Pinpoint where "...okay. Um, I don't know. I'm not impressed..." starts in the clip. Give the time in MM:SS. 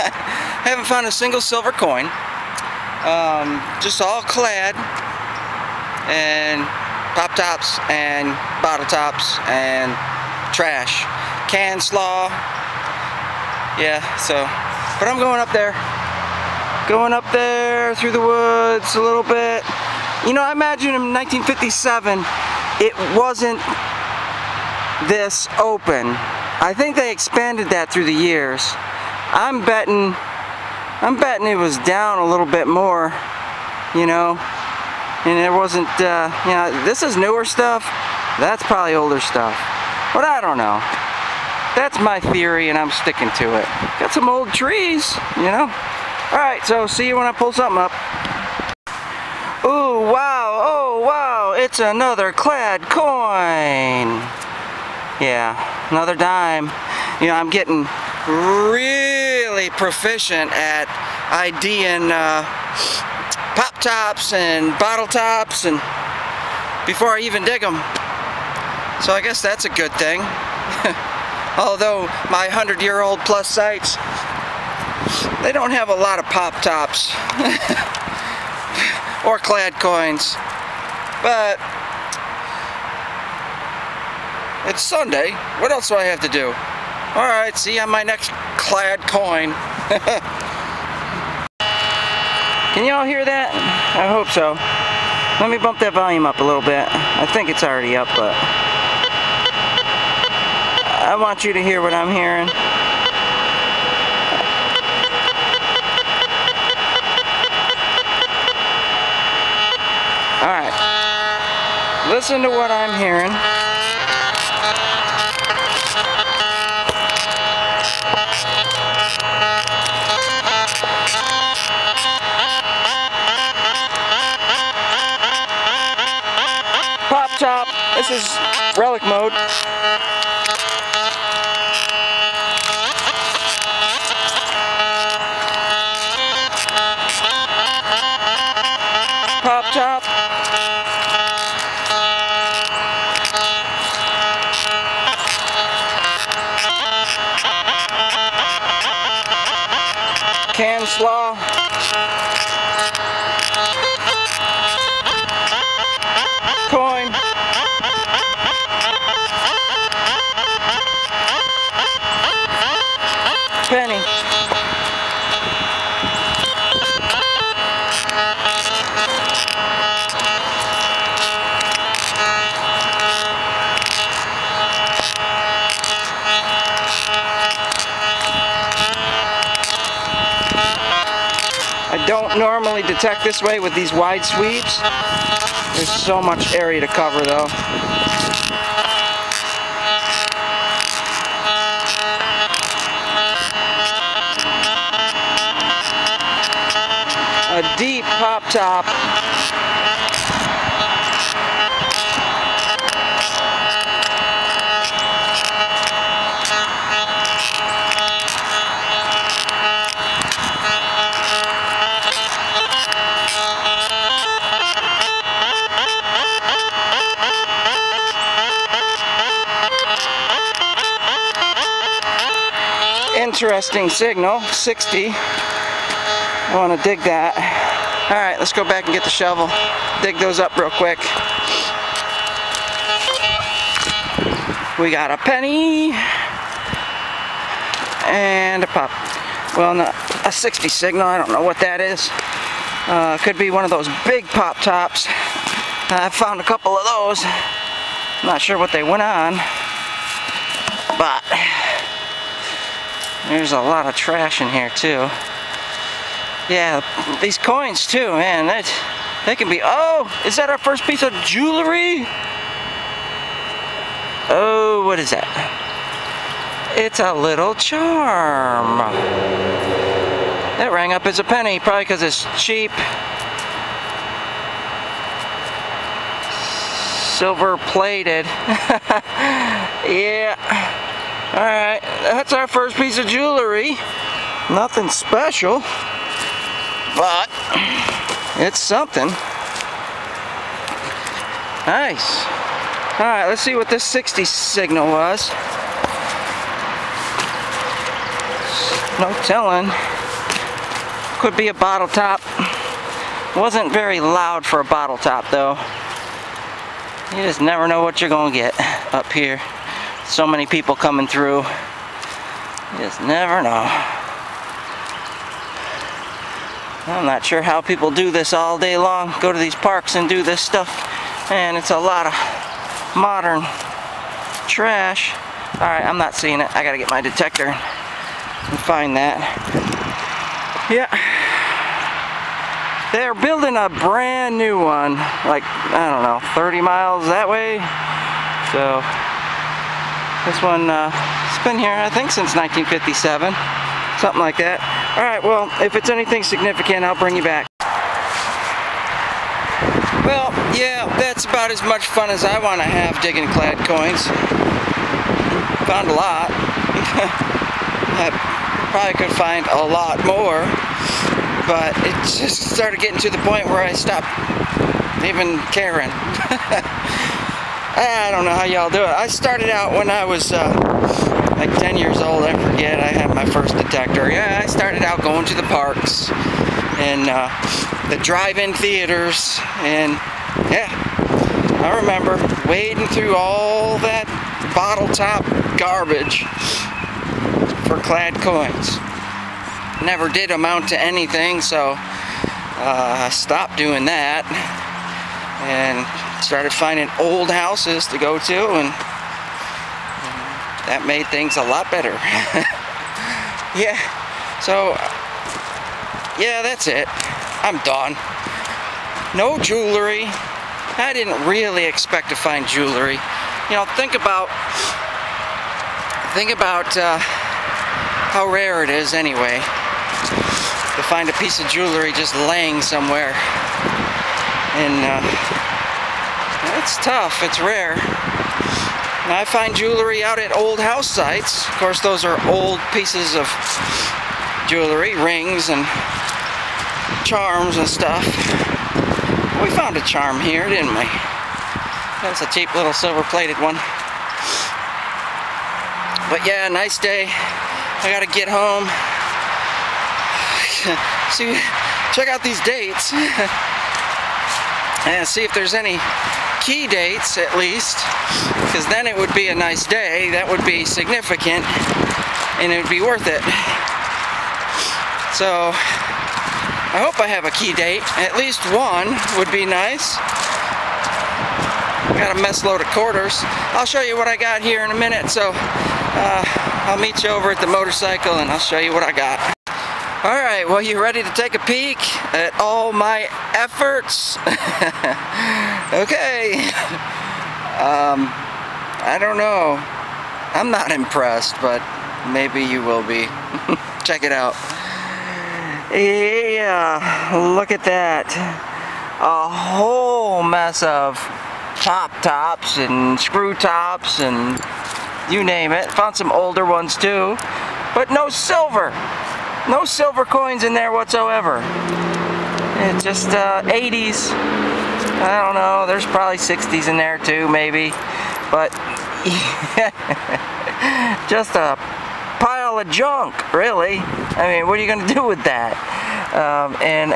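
08:05.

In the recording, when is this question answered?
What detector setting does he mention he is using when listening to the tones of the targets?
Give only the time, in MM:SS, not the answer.
02:08.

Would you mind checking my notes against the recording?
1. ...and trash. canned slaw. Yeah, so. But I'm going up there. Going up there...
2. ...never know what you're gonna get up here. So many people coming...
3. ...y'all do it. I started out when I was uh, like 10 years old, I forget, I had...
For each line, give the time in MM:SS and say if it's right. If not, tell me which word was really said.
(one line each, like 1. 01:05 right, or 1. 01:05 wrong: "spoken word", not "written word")
1. 00:09 right
2. 05:07 right
3. 06:08 right.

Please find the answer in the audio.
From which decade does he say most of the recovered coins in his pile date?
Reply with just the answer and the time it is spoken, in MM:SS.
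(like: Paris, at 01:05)
80s, at 08:33.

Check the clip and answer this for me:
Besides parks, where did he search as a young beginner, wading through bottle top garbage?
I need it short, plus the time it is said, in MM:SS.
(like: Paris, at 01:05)
drive-in theaters, at 06:17.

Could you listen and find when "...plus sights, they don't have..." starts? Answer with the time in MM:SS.
01:13.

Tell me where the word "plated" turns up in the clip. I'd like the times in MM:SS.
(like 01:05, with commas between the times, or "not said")
04:37, 07:22.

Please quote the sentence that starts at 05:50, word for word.
Well, yeah, that's about as much fun as I want to have digging clad coins.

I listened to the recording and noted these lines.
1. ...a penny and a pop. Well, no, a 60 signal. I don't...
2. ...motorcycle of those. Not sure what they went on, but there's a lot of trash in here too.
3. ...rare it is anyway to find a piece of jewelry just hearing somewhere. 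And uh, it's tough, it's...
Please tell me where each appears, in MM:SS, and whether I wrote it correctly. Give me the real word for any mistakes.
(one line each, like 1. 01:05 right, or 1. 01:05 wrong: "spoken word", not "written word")
1. 03:55 right
2. 04:06 wrong: "couple", not "motorcycle"
3. 06:58 wrong: "laying", not "hearing".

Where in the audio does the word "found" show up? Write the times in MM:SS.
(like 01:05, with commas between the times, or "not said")
00:00, 04:06, 05:55, 07:19, 08:25.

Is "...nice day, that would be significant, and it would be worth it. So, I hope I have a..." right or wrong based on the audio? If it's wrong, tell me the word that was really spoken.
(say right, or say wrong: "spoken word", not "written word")
right.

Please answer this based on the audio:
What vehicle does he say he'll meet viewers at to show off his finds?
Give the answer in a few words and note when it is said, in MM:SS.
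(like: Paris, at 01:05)
motorcycle, at 07:57.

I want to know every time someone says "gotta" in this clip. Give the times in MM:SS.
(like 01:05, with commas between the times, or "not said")
05:26, 07:27.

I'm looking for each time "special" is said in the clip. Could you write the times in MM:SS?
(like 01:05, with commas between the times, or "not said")
04:44.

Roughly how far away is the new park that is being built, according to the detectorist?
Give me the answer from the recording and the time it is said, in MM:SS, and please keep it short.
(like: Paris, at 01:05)
30 miles, at 05:36.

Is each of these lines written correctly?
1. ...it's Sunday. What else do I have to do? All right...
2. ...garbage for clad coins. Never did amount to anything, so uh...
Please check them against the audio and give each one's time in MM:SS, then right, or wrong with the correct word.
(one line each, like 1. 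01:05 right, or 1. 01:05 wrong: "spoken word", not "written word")
1. 01:24 right
2. 06:25 right.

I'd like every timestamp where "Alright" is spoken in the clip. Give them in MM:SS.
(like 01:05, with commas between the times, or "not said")
01:50, 05:25, 05:44.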